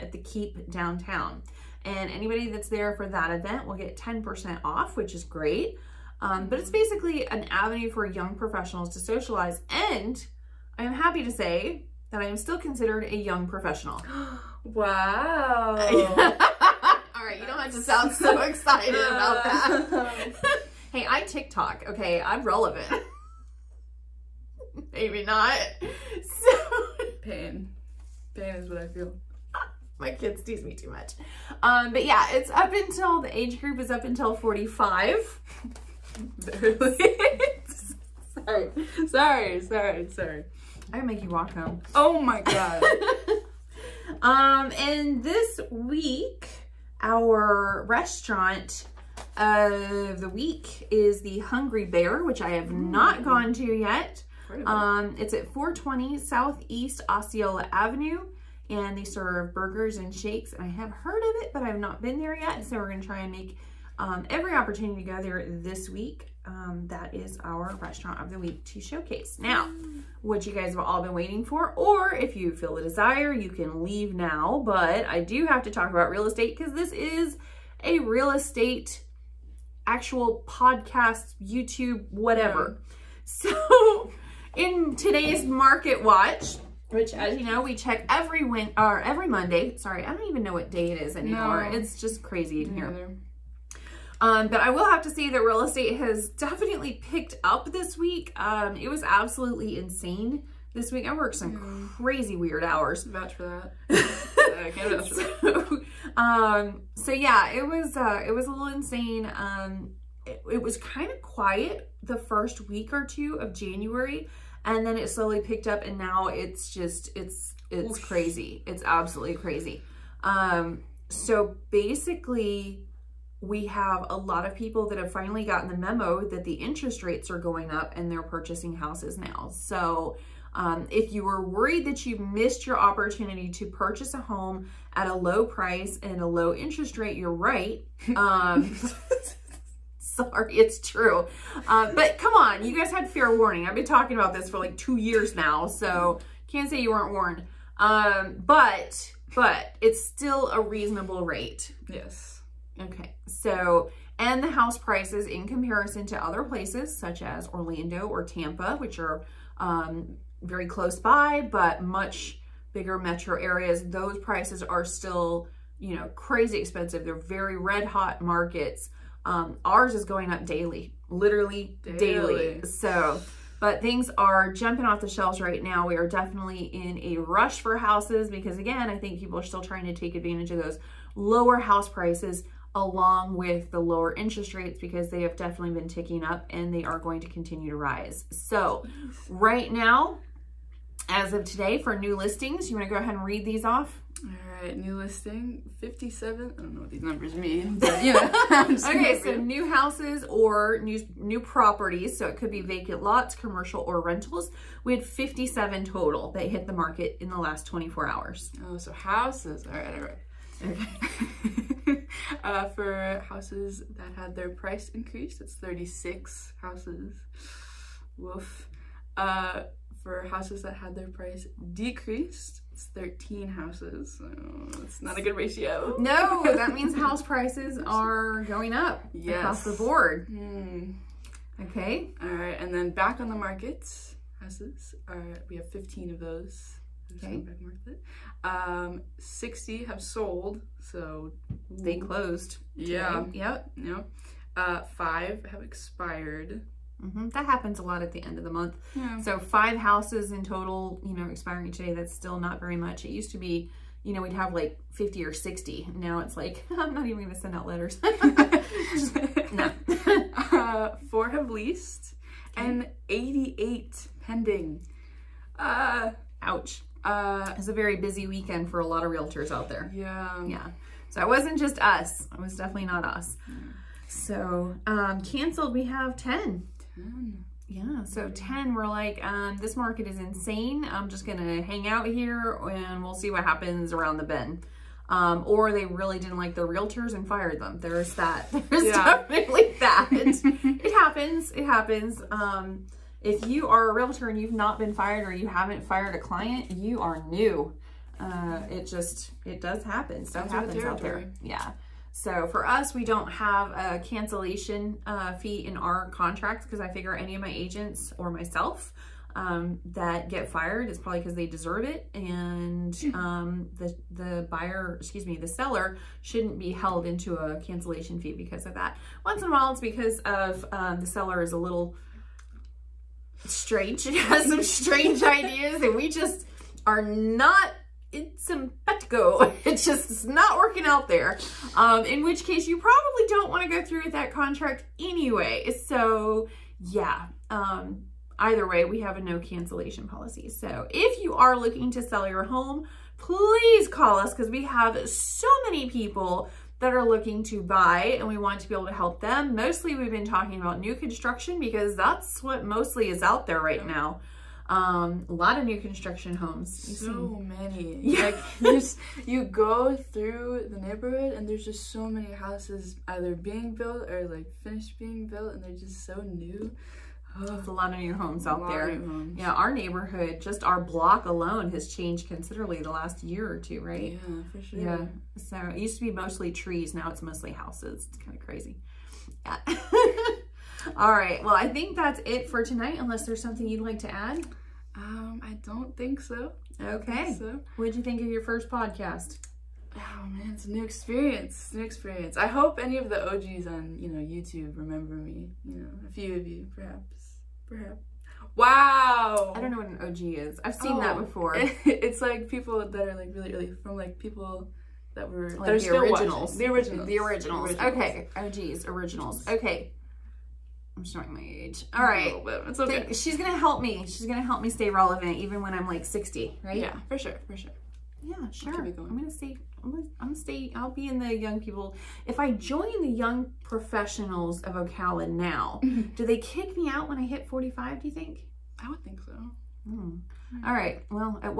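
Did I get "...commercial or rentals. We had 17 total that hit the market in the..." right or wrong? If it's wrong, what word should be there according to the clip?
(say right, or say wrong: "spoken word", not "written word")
wrong: "57", not "17".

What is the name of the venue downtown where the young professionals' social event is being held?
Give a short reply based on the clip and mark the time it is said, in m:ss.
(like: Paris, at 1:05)
The Keep, at 0:00.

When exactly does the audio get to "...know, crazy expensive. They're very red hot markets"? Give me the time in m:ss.
2:45.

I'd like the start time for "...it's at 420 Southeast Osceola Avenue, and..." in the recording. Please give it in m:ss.
0:55.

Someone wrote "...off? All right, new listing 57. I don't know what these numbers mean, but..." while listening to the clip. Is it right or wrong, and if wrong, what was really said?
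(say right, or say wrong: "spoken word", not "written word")
right.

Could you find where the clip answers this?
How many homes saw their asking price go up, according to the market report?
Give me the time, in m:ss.
3:35.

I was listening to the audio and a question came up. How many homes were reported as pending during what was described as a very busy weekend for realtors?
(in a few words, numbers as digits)
88.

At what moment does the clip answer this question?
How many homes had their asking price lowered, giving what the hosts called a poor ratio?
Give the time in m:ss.
3:42.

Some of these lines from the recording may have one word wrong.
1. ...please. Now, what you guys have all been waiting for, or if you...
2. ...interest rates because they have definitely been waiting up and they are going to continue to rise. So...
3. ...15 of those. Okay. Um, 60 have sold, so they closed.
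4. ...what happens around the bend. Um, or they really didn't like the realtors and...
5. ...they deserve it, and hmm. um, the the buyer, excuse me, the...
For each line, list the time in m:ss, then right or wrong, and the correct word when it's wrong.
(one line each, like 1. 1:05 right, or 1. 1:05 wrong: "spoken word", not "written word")
1. 1:08 wrong: "showcase", not "please"
2. 3:04 wrong: "ticking", not "waiting"
3. 3:55 right
4. 4:43 right
5. 5:11 right.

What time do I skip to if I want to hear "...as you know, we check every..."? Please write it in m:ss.
1:27.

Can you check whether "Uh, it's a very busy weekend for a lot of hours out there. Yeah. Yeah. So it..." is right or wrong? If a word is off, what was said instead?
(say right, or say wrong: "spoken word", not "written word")
wrong: "realtors", not "hours".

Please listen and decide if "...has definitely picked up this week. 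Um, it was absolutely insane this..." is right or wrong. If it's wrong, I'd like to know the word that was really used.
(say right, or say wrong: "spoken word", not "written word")
right.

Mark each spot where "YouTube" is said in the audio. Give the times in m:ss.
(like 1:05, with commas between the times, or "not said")
1:21, 6:34.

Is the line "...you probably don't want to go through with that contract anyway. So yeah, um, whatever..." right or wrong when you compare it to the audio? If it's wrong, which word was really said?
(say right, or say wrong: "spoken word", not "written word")
wrong: "either", not "whatever".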